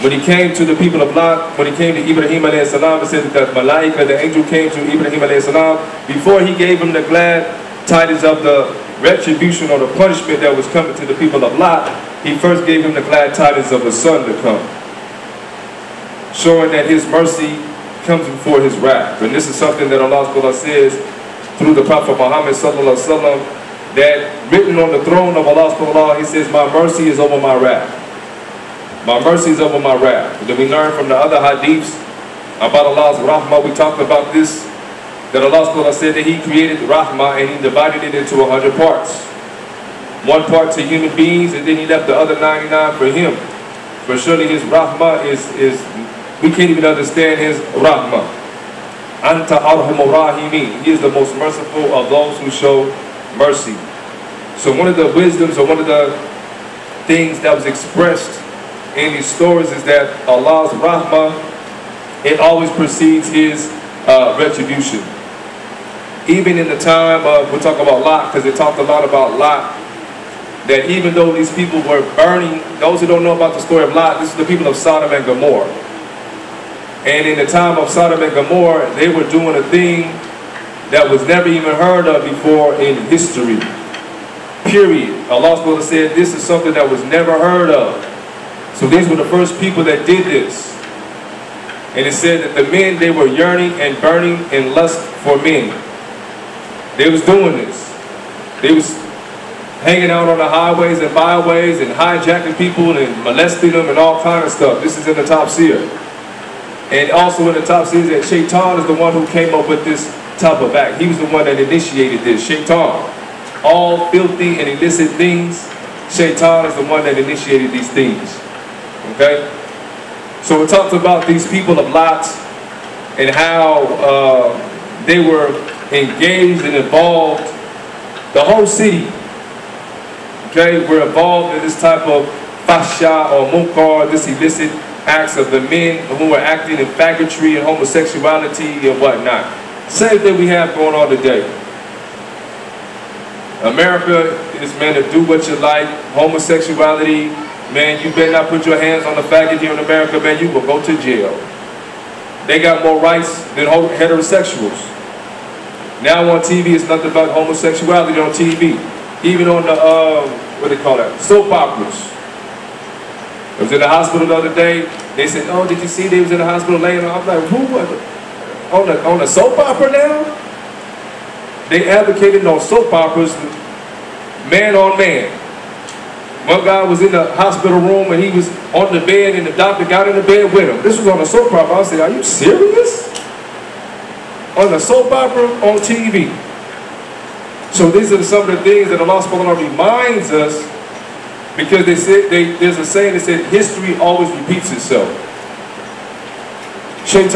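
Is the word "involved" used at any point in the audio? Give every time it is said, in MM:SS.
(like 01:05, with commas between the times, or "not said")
02:06, 02:11.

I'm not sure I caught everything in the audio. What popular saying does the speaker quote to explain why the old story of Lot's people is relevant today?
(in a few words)
History always repeats itself.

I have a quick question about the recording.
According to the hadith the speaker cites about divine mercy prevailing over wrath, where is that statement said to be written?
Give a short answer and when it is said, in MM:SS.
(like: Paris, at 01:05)
The throne of Allah, at 00:25.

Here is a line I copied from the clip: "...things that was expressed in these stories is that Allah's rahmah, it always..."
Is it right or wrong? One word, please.
right.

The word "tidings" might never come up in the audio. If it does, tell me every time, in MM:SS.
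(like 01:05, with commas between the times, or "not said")
00:07, 00:13.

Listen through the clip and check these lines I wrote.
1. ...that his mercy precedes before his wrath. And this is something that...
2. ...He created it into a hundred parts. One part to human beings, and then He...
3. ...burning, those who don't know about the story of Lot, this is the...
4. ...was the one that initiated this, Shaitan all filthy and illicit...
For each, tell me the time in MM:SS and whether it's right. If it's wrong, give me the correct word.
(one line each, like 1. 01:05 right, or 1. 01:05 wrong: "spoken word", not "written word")
1. 00:16 wrong: "comes", not "precedes"
2. 00:37 wrong: "divided", not "created"
3. 01:12 right
4. 01:51 right.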